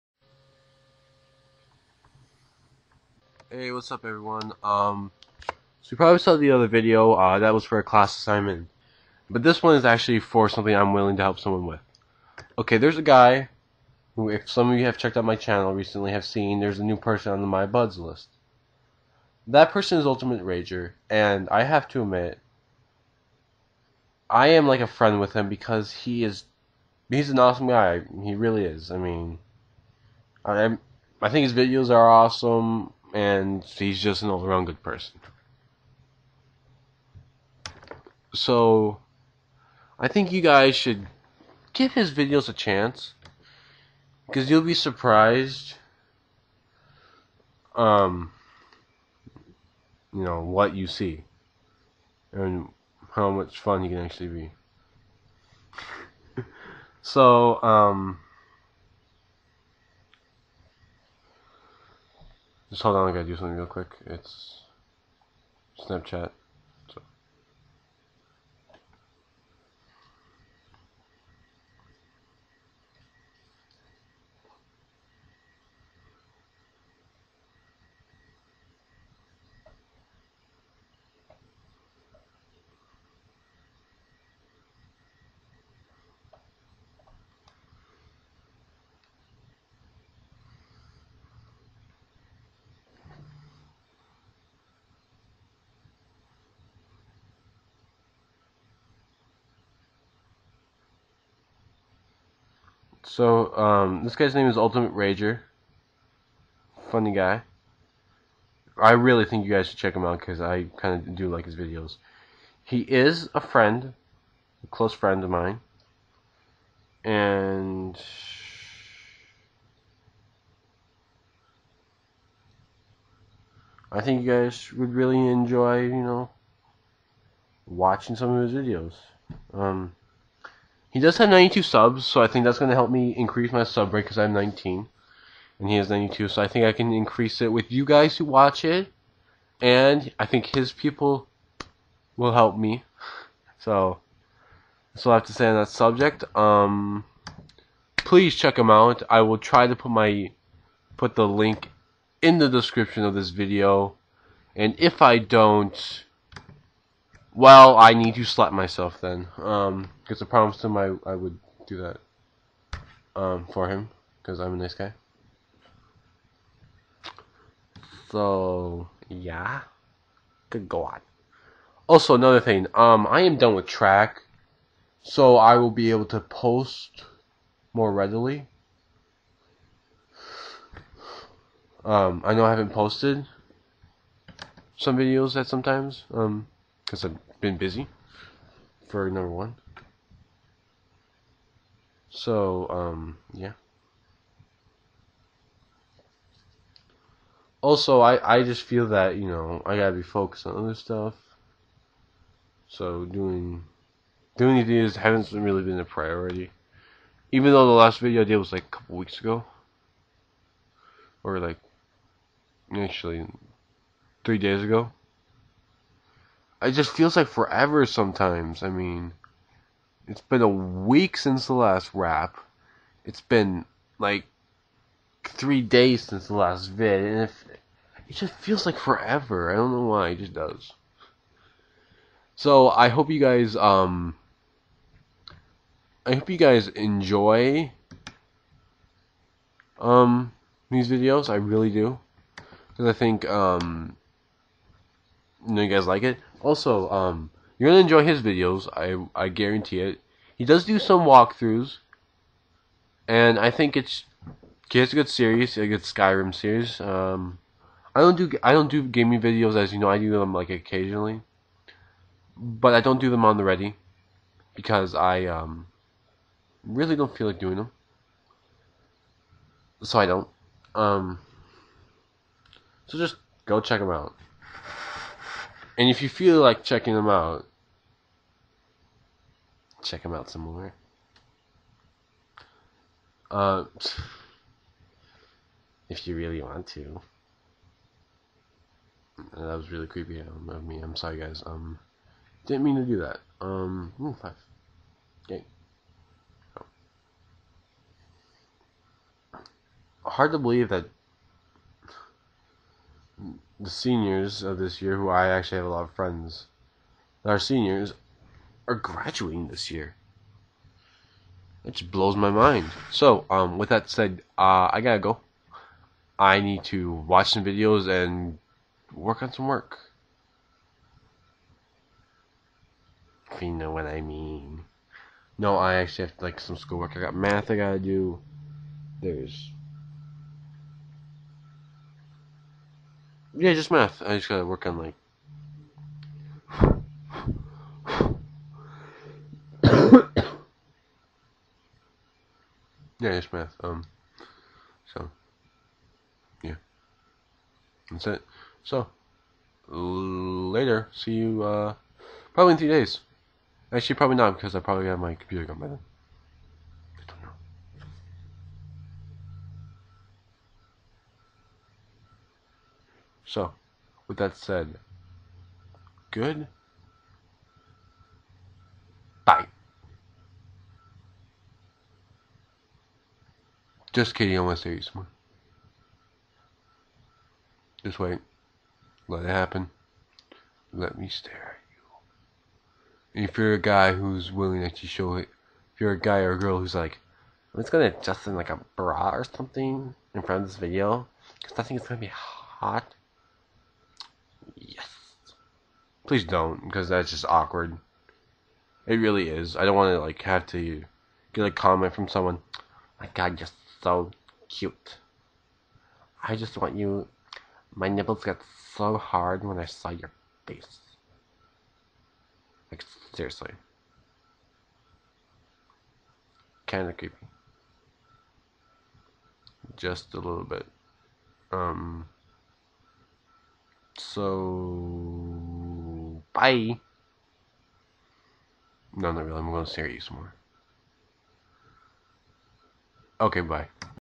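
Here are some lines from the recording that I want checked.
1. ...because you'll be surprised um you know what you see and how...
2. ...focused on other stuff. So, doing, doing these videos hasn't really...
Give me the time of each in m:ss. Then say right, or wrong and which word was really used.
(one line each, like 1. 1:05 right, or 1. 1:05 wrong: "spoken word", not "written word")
1. 0:44 right
2. 3:20 right.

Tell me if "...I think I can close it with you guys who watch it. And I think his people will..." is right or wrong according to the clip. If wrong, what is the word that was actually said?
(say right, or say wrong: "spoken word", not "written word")
wrong: "increase", not "close".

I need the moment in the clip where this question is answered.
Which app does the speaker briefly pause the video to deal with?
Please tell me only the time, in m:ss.
1:05.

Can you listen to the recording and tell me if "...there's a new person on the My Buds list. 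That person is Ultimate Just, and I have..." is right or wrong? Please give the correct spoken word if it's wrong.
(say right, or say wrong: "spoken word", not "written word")
wrong: "Rager", not "Just".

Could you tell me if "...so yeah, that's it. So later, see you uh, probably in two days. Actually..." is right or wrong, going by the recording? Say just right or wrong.
wrong.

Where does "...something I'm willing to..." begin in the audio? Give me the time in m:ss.
0:10.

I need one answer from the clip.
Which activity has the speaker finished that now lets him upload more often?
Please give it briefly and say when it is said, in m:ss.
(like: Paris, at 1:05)
track, at 2:53.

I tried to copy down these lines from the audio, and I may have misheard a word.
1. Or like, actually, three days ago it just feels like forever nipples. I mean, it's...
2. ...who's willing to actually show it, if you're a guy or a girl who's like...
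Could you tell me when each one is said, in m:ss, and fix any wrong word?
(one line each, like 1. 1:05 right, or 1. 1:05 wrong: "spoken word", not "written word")
1. 3:31 wrong: "sometimes", not "nipples"
2. 6:23 right.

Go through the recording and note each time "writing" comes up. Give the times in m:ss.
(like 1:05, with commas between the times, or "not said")
not said.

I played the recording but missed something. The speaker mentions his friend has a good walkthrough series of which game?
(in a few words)
Skyrim.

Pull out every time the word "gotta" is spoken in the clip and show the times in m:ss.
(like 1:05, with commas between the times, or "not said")
1:03, 3:19, 5:14, 5:27, 5:34.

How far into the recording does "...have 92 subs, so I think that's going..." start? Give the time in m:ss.
2:11.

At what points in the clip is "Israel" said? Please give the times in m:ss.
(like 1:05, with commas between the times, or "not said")
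not said.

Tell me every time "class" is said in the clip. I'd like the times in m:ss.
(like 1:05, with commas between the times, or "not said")
0:07.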